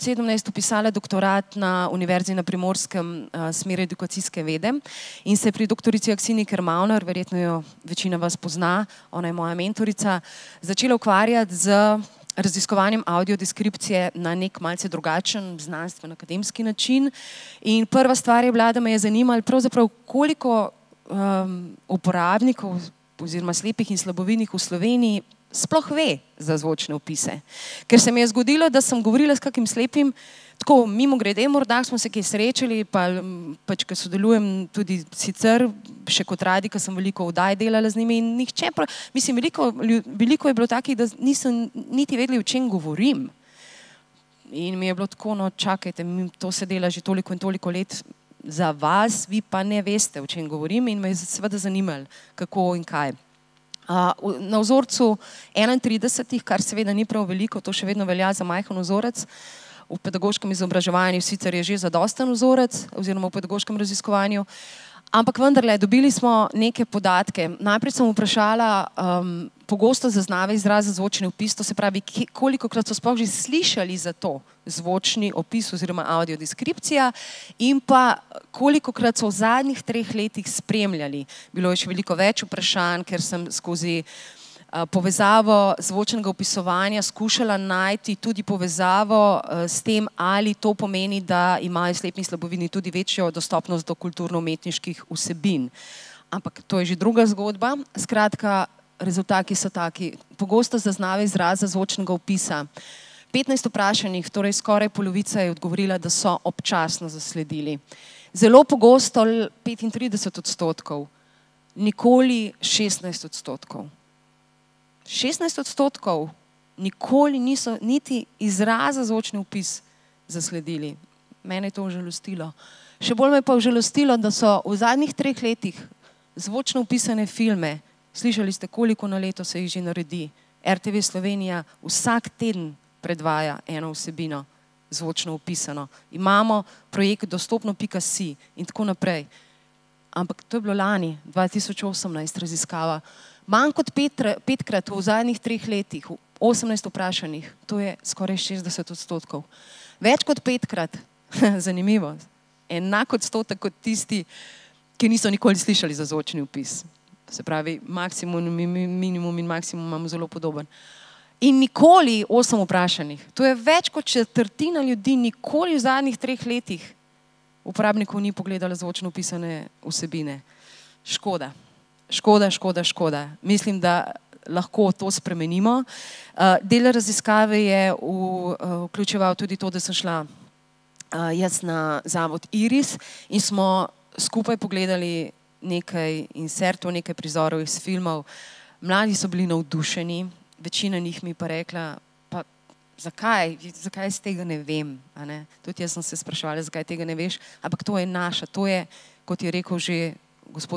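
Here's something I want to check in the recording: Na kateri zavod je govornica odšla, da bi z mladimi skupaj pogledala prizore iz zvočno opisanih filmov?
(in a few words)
Zavod Iris.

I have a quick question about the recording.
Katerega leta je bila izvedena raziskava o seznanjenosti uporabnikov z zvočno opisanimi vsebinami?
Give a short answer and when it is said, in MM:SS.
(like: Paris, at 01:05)
2018, at 02:21.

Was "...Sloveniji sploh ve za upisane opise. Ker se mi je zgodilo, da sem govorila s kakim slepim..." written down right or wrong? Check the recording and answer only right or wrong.
wrong.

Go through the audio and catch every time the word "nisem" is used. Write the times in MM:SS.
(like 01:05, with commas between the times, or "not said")
00:41.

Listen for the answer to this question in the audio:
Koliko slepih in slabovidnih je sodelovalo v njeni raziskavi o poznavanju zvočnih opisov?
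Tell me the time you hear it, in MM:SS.
00:55.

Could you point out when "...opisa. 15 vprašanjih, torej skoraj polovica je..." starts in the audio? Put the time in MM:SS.
01:42.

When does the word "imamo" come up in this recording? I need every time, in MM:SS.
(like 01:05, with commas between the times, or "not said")
02:16, 02:39.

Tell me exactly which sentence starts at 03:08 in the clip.
Mladi so bili navdušeni, večina njih mi pa rekla, pa zakaj, zakaj jaz tega ne vem?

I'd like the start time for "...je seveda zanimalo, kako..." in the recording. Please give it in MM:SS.
00:51.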